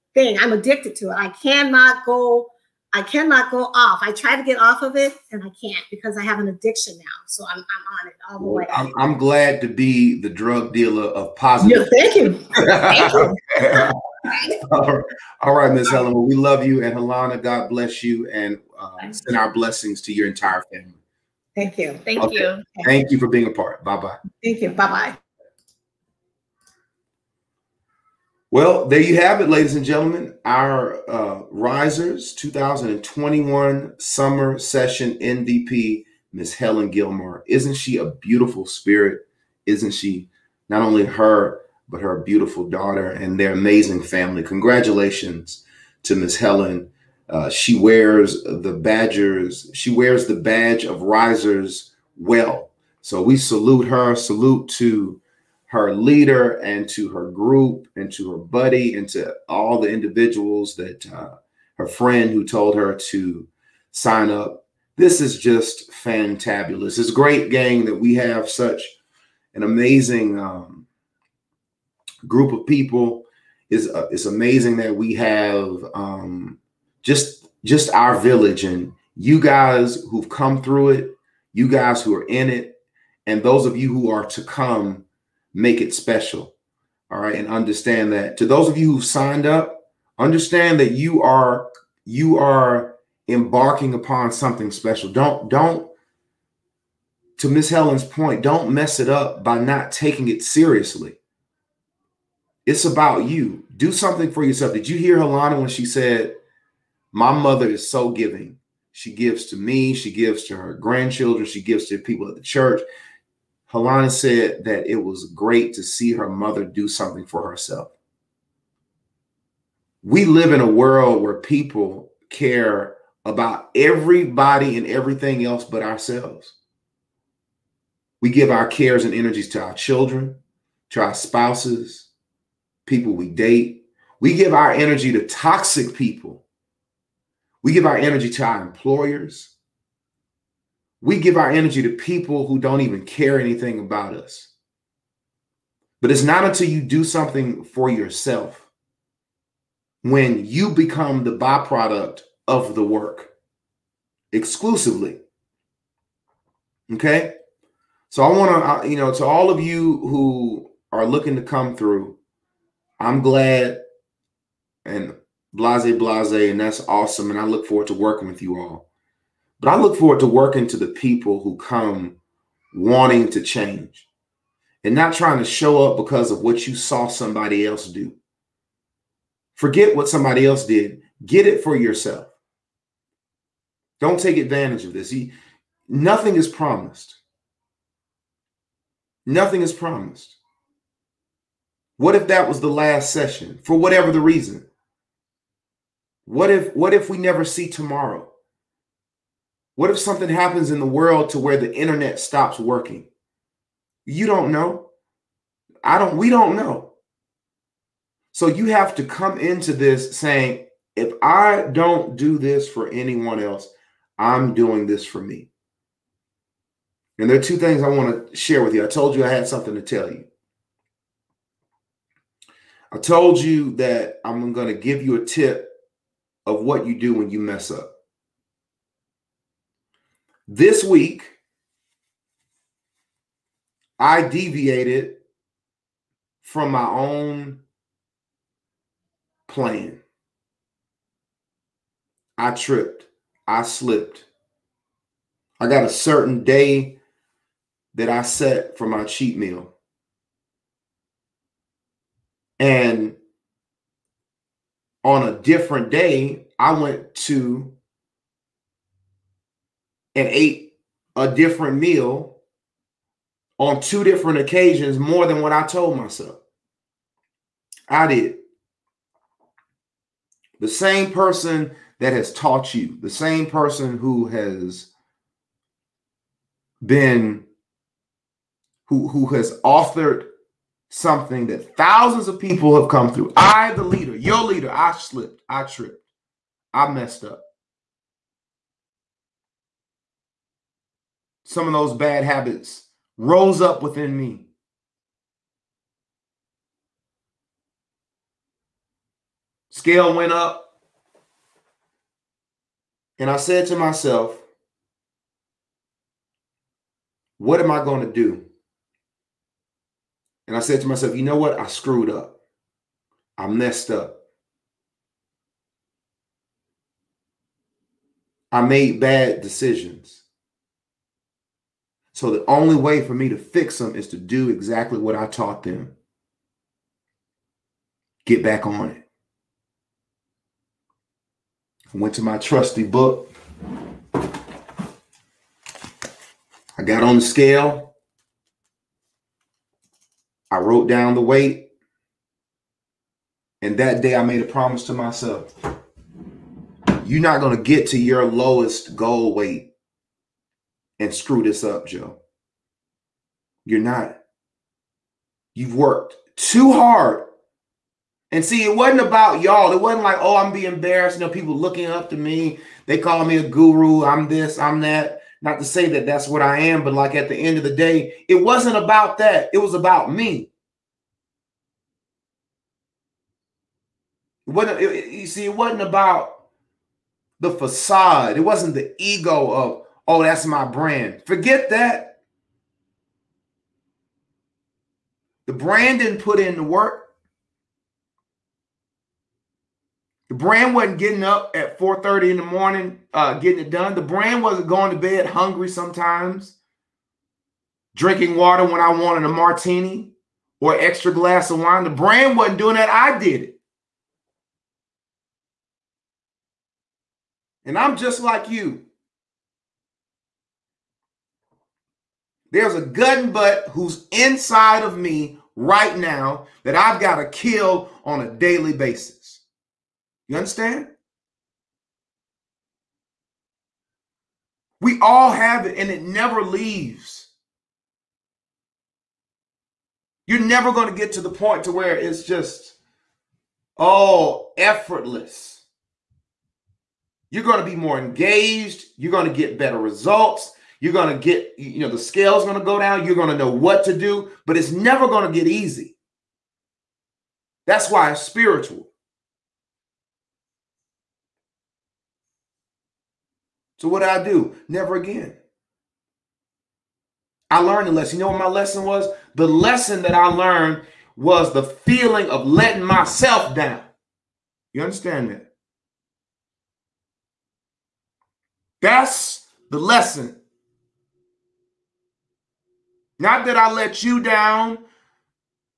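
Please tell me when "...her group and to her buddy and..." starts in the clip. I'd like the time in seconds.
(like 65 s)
57 s.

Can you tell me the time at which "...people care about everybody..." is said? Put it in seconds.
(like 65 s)
121 s.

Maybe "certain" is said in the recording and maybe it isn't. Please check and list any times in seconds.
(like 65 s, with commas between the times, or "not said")
245 s.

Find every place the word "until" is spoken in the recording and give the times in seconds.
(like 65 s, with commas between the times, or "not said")
146 s.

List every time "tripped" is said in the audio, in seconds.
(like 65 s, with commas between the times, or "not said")
242 s, 285 s.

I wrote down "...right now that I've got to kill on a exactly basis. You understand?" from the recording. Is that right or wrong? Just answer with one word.
wrong.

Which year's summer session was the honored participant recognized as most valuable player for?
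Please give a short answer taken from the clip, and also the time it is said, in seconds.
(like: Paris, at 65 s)
2021, at 32 s.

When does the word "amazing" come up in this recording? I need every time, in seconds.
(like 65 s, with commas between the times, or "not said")
43 s, 69 s, 74 s.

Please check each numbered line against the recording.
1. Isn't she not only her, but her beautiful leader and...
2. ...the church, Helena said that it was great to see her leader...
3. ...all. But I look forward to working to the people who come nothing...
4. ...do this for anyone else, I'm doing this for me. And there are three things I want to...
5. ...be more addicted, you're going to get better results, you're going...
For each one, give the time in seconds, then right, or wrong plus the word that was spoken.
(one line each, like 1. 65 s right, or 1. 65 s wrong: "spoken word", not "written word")
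1. 39 s wrong: "daughter", not "leader"
2. 112 s wrong: "mother", not "leader"
3. 168 s wrong: "wanting", not "nothing"
4. 212 s wrong: "two", not "three"
5. 437 s wrong: "engaged", not "addicted".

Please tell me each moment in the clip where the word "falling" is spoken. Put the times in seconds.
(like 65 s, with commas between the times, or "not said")
not said.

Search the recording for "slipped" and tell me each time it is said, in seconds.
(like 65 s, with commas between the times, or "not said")
243 s, 284 s.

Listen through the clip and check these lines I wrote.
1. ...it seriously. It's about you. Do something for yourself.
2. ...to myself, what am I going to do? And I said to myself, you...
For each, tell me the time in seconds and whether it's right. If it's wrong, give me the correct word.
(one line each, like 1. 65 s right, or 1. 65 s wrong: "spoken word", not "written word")
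1. 100 s right
2. 303 s right.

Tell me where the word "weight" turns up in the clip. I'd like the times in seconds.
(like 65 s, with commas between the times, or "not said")
341 s, 349 s.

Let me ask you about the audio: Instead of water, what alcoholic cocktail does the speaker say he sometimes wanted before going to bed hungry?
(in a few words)
martini.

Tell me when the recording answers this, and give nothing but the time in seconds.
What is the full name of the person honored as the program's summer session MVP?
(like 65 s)
36 s.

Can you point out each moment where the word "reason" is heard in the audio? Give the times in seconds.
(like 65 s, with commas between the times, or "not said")
194 s.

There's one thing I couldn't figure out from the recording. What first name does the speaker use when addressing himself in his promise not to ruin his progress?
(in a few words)
Joe.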